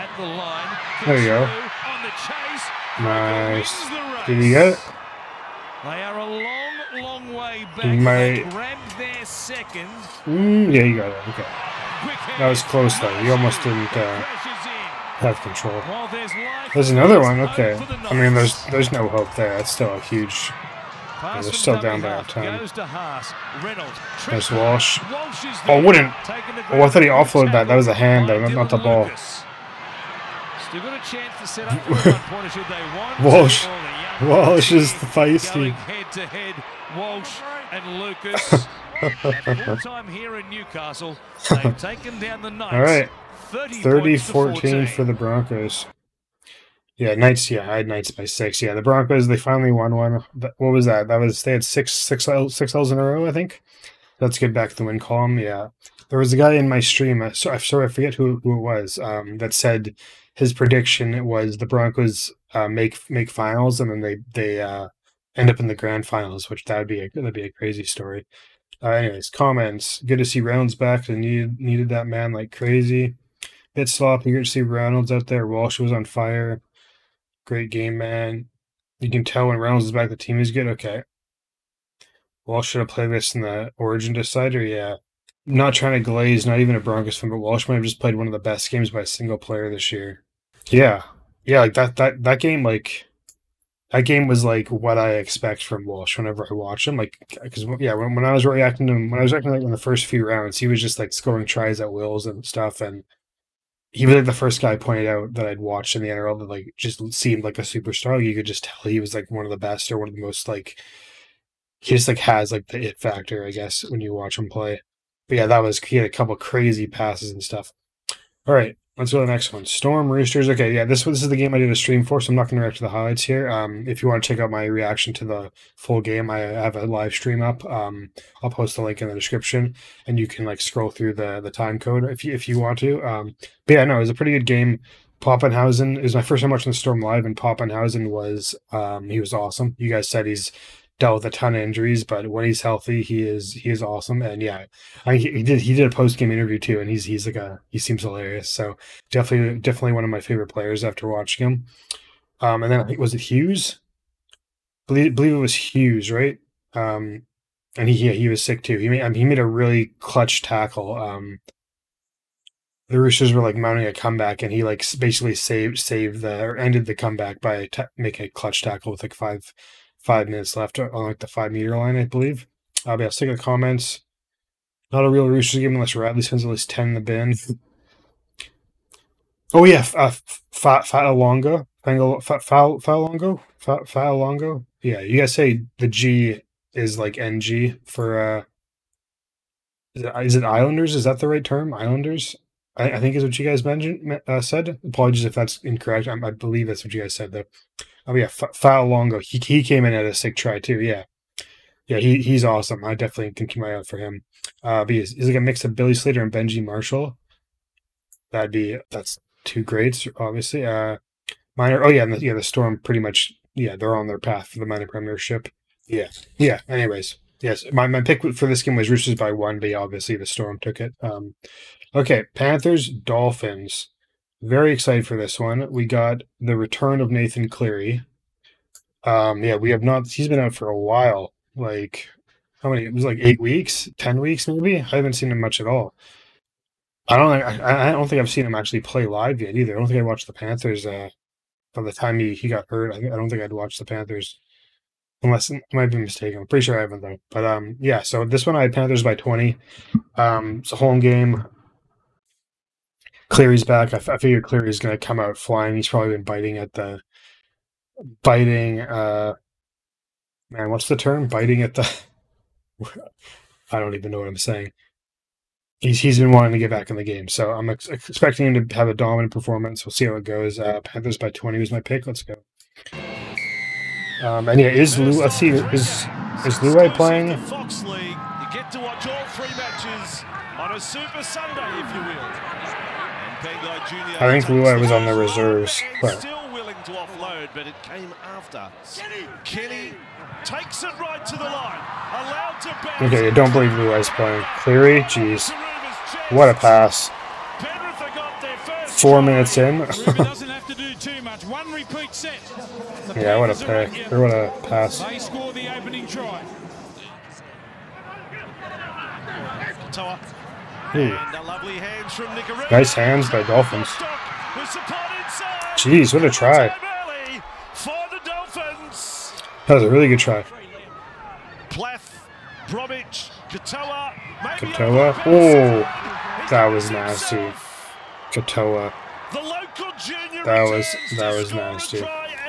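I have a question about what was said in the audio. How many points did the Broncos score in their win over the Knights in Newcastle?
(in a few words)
30.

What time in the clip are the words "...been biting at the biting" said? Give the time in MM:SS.
04:16.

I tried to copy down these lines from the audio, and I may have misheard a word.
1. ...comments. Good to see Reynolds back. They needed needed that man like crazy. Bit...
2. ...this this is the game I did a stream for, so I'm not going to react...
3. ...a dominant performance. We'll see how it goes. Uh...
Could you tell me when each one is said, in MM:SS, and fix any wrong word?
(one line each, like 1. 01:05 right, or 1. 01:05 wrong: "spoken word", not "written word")
1. 01:09 right
2. 02:00 right
3. 04:28 right.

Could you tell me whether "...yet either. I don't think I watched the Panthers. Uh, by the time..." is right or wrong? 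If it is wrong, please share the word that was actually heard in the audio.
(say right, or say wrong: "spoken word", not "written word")
right.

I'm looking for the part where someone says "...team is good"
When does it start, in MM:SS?
01:20.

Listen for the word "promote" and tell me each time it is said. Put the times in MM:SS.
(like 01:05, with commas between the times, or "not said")
not said.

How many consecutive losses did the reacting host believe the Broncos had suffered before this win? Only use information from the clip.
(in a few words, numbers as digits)
6.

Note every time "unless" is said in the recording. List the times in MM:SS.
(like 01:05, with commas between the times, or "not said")
02:55, 04:05.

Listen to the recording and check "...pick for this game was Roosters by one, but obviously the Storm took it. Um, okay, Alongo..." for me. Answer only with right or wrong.
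wrong.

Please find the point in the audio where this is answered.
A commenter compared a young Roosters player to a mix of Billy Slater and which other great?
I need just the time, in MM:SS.
03:26.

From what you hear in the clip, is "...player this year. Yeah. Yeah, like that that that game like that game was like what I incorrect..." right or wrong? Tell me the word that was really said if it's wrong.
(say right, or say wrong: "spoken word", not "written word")
wrong: "expect", not "incorrect".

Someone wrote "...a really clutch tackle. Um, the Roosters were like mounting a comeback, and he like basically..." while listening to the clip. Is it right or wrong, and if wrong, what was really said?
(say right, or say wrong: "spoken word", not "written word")
right.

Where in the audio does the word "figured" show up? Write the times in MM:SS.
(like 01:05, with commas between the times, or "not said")
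04:14.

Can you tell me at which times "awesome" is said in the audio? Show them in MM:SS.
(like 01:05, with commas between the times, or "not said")
02:19, 02:23, 03:22.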